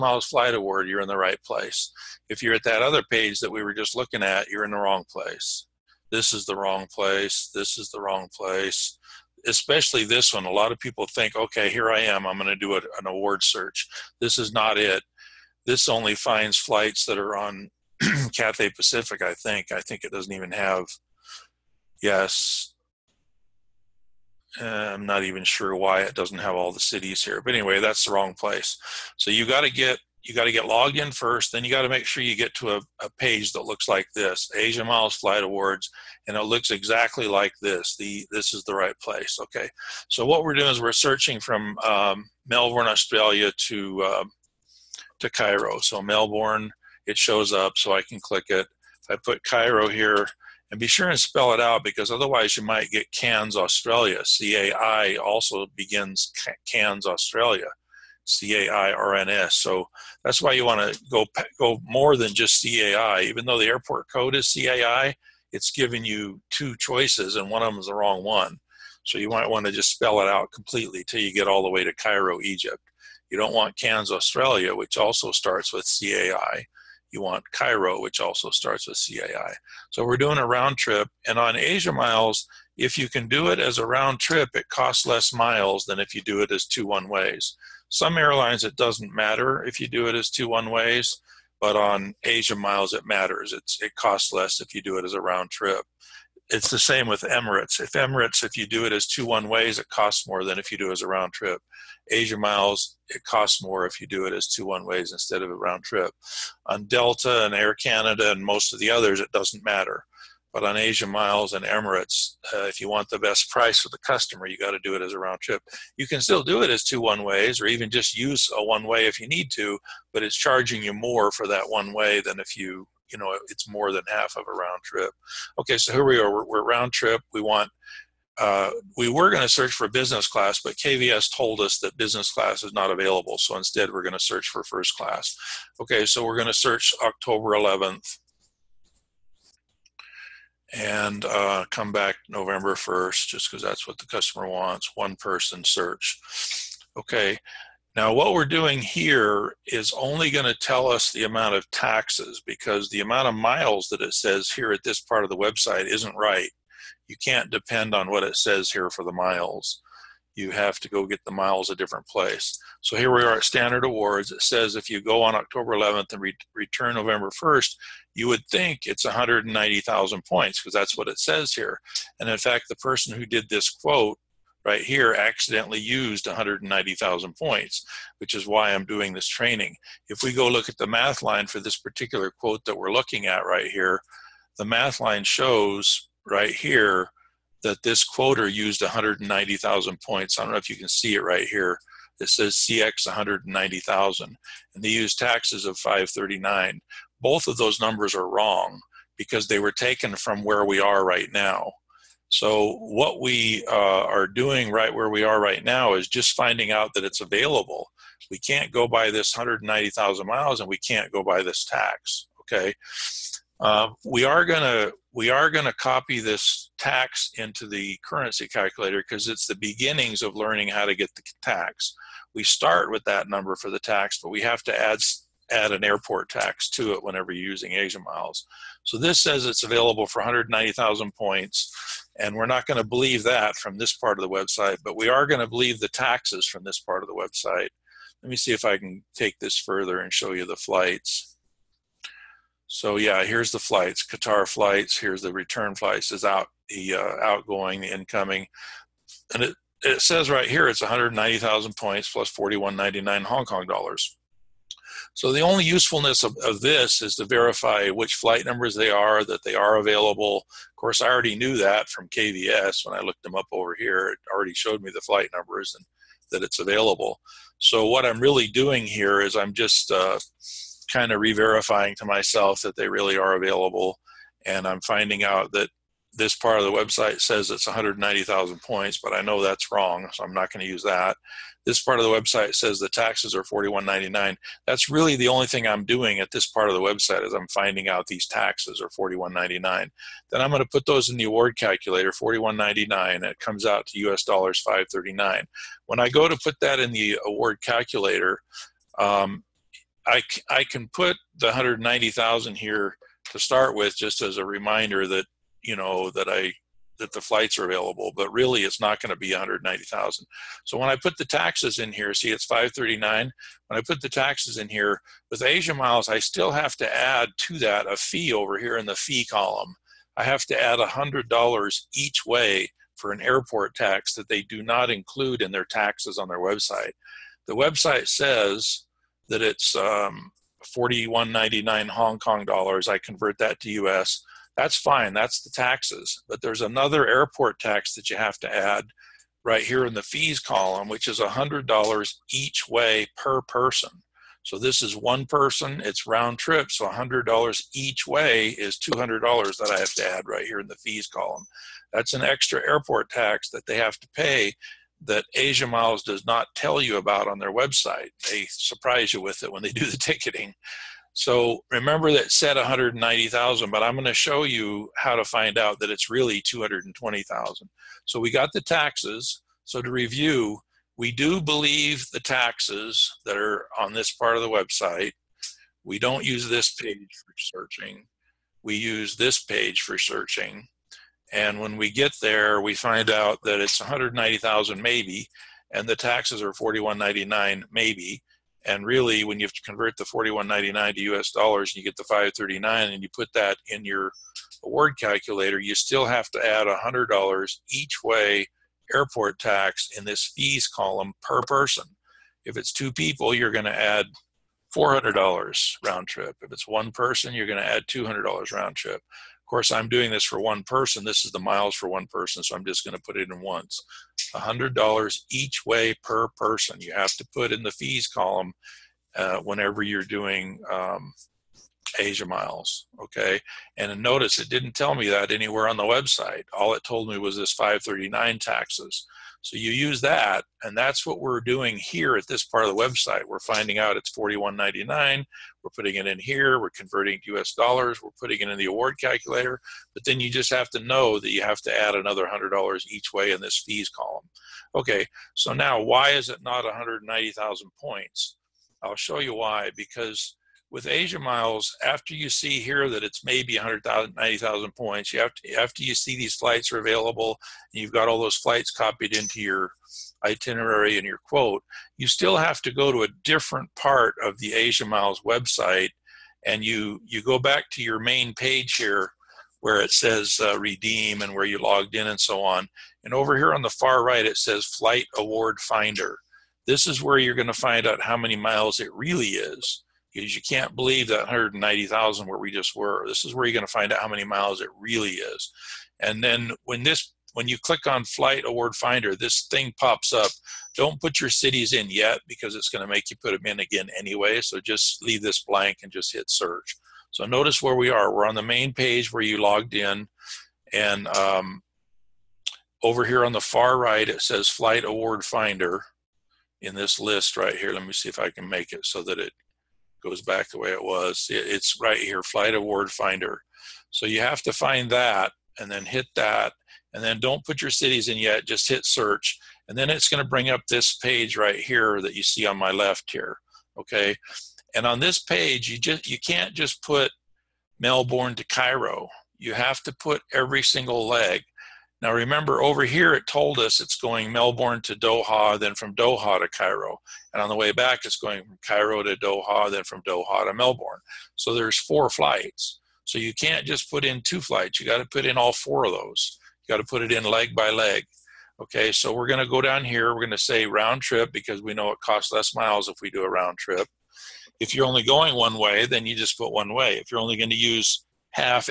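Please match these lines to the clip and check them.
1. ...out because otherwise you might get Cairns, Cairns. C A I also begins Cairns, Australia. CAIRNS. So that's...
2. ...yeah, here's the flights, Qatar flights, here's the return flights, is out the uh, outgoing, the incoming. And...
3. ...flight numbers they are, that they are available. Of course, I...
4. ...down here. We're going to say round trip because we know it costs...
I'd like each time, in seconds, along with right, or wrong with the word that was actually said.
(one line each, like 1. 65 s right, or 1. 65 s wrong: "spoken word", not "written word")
1. 51 s wrong: "Australia", not "Cairns"
2. 242 s right
3. 258 s right
4. 549 s right.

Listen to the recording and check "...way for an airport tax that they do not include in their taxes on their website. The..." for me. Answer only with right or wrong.
right.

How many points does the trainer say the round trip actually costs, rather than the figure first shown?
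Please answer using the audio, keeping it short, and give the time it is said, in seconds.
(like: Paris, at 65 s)
220,000, at 365 s.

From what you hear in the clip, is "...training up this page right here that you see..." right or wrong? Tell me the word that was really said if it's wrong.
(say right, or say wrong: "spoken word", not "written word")
wrong: "bring", not "training".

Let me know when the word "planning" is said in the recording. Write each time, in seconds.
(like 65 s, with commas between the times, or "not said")
not said.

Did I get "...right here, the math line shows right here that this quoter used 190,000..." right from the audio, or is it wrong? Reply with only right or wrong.
right.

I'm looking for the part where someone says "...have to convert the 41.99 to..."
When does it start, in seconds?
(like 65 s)
389 s.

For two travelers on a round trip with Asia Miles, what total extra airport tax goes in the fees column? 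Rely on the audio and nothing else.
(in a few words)
$400.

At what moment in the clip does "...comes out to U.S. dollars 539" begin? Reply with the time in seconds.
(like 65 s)
293 s.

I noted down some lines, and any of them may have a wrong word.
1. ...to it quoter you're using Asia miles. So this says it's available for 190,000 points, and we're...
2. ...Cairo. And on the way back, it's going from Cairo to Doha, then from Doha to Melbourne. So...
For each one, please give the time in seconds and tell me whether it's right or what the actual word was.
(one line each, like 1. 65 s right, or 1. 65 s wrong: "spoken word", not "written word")
1. 226 s wrong: "whenever", not "quoter"
2. 536 s right.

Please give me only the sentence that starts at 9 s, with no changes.
Especially this one, a lot of people think, okay, here I am, I'm going to do an award search.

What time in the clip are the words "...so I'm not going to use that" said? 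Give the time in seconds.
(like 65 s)
280 s.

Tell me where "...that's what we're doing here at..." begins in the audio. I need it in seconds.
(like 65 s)
430 s.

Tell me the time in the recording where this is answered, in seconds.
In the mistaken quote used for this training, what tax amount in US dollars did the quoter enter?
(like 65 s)
195 s.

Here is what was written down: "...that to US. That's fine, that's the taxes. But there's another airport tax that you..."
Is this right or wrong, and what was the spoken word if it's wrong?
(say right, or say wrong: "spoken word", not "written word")
right.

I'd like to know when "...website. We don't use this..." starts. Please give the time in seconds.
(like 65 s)
374 s.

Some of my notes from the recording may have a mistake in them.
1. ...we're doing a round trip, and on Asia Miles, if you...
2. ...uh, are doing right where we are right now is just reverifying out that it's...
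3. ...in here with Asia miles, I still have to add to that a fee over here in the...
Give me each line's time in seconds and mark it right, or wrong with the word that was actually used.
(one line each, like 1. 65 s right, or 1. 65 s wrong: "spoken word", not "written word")
1. 80 s right
2. 203 s wrong: "finding", not "reverifying"
3. 314 s right.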